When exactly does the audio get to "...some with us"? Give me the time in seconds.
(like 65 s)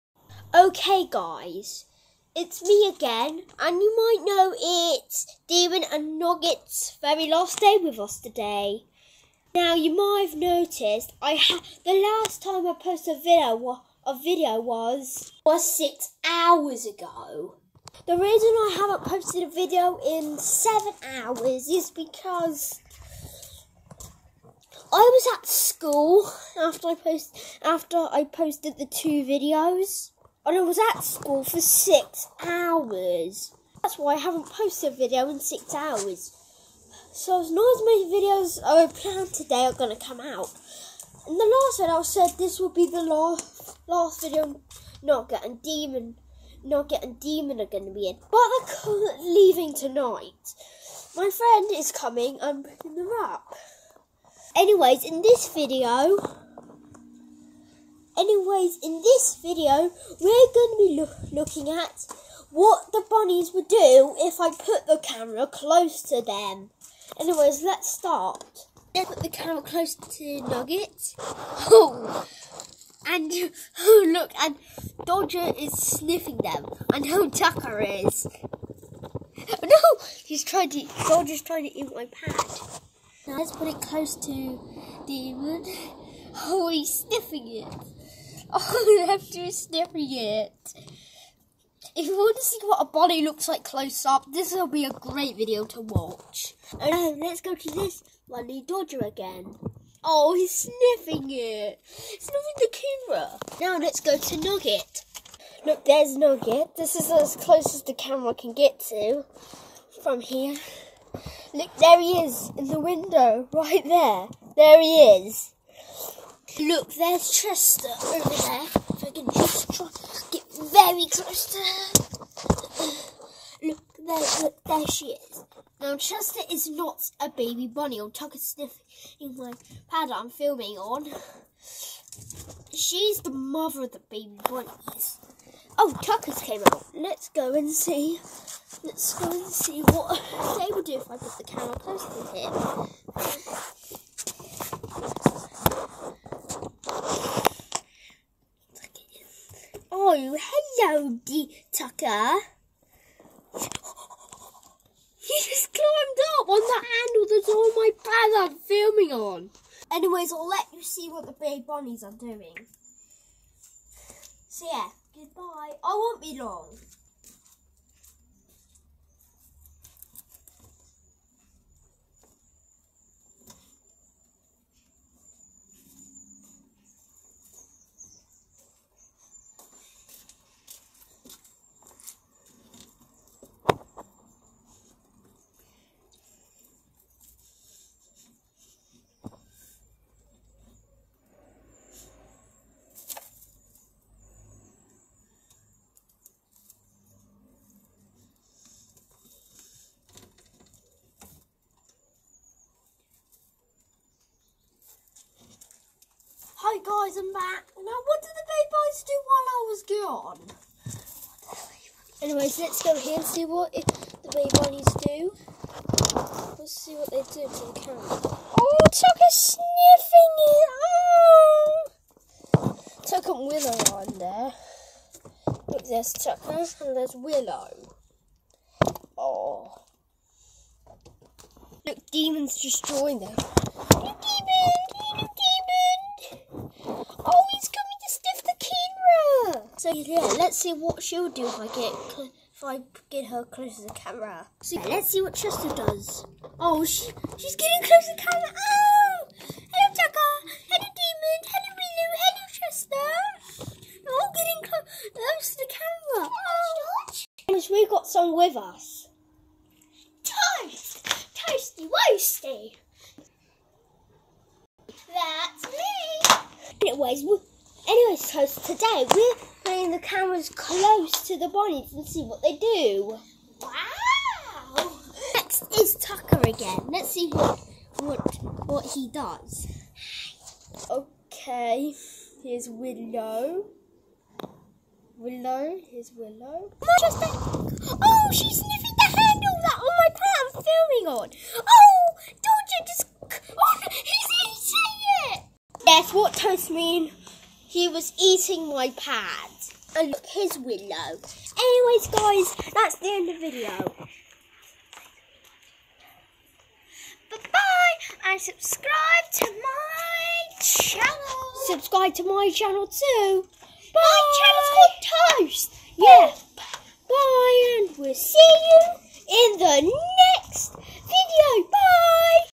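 258 s.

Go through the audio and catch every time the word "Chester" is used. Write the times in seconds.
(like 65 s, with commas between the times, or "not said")
117 s, 125 s, 245 s, 252 s.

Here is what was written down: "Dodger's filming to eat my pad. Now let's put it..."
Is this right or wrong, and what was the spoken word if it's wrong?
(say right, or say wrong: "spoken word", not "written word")
wrong: "trying", not "filming".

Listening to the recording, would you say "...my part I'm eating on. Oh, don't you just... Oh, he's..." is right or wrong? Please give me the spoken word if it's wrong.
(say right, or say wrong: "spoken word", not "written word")
wrong: "filming", not "eating".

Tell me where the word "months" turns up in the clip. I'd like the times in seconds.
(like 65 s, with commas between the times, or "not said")
not said.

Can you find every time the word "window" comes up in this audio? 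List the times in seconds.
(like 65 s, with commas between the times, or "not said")
112 s, 300 s.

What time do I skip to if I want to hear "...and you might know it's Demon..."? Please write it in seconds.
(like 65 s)
3 s.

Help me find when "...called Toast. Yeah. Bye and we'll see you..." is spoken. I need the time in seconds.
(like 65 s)
314 s.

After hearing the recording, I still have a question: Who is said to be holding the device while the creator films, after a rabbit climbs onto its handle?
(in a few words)
My brother.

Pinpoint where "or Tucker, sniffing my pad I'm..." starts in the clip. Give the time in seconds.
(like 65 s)
128 s.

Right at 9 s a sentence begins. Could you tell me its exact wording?
Now, you might have noticed I ha- the last time I posted a video a video was was six hours ago.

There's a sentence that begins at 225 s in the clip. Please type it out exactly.
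Look, there's Tucker and there's Willow.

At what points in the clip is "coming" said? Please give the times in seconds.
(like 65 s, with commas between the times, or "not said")
51 s.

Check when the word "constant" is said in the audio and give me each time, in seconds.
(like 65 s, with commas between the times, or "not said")
not said.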